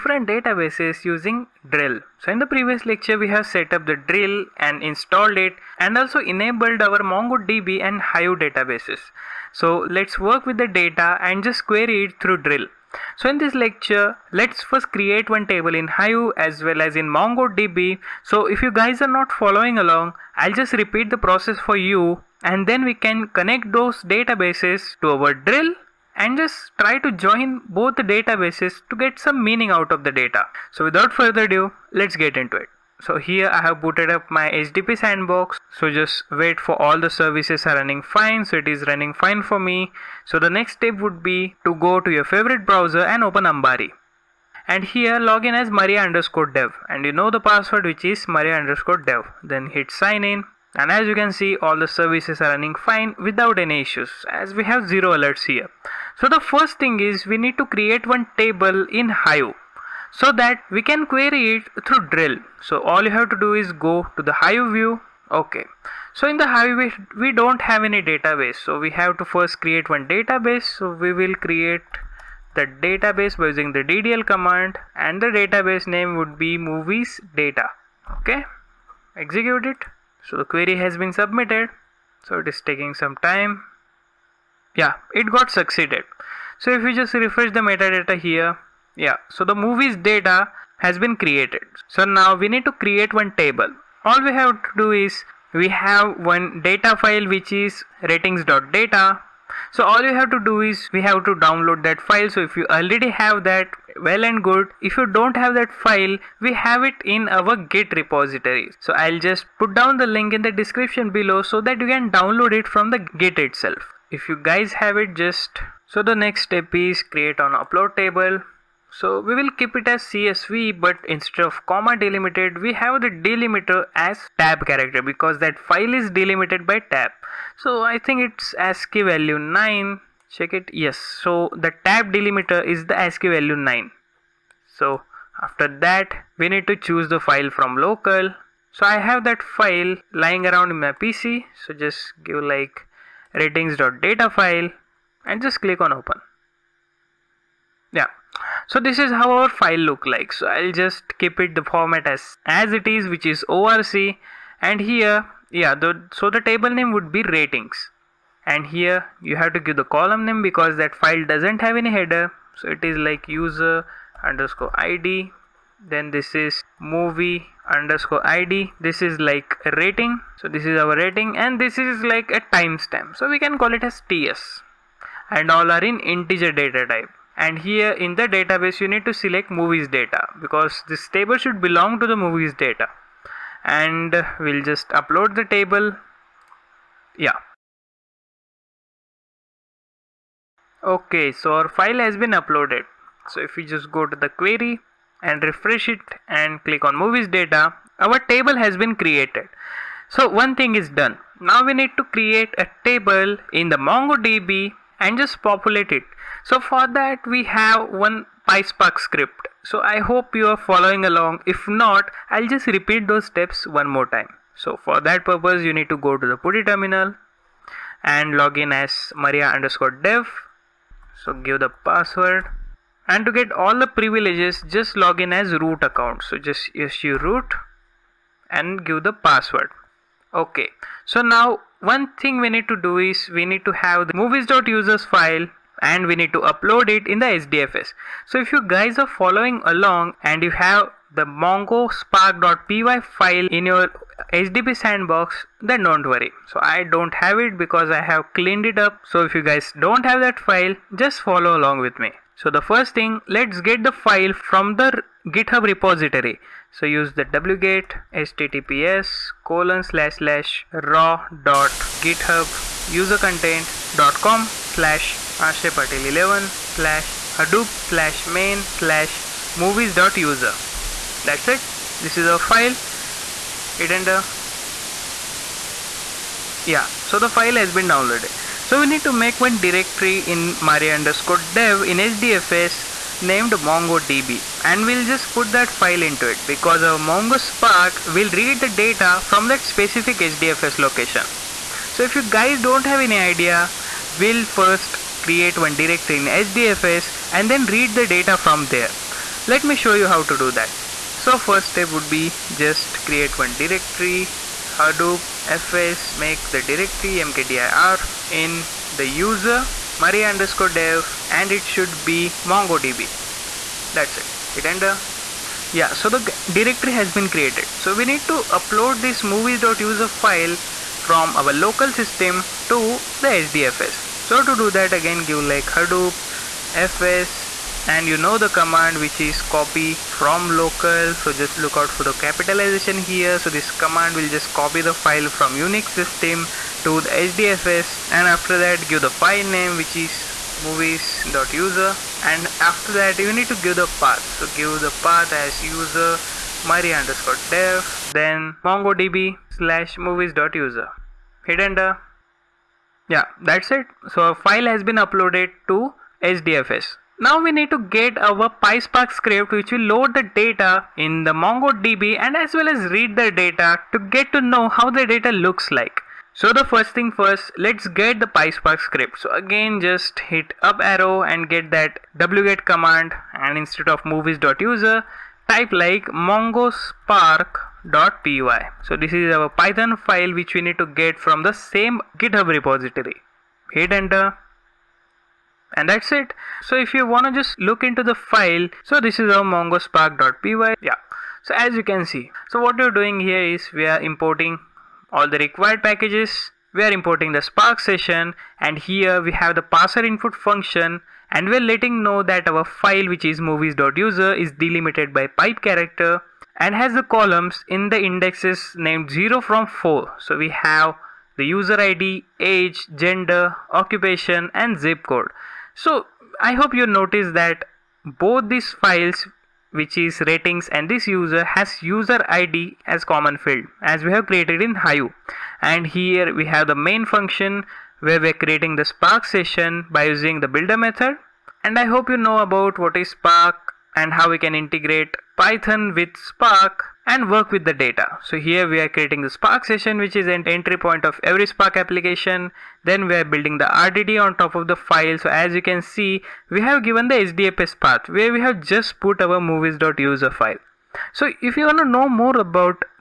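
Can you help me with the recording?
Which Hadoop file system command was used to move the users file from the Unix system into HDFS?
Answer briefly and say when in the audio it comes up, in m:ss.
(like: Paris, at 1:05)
copy from local, at 5:29.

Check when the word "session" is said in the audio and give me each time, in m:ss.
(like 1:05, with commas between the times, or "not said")
6:37, 7:09, 7:19.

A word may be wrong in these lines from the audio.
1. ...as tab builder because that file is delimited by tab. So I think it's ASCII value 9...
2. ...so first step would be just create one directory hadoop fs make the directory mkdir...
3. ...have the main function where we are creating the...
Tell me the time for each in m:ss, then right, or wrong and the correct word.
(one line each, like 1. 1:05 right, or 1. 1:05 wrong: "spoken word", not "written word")
1. 2:03 wrong: "character", not "builder"
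2. 5:01 right
3. 7:06 right.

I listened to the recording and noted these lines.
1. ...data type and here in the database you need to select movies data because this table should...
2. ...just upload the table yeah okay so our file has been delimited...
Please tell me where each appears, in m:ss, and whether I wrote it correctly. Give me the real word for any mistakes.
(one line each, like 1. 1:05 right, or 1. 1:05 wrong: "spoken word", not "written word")
1. 2:56 right
2. 3:04 wrong: "uploaded", not "delimited".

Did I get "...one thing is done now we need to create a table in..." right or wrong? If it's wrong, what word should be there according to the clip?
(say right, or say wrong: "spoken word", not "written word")
right.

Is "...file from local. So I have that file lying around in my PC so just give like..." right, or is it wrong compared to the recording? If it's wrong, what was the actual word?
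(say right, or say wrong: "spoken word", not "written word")
right.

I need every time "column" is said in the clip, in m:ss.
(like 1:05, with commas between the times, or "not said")
2:39, 6:47.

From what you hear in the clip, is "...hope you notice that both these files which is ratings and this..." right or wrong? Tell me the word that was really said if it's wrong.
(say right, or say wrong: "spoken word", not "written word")
right.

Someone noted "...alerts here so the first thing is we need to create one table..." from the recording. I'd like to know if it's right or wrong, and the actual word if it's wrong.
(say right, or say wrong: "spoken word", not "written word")
right.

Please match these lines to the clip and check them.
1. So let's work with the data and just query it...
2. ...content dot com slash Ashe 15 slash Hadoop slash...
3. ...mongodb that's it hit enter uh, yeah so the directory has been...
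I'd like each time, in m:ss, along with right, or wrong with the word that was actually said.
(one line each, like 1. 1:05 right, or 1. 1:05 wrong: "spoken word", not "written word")
1. 0:09 right
2. 4:23 wrong: "11", not "15"
3. 5:12 right.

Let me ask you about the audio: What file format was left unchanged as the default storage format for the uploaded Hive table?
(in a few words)
ORC.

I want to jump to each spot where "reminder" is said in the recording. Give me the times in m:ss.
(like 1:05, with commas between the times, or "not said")
not said.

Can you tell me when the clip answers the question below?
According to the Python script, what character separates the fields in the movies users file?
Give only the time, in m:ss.
6:45.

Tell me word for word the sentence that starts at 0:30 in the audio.
So without further ado, let's get into it.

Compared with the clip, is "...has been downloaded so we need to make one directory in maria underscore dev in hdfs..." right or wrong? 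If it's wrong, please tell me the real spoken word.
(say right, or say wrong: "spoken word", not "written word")
right.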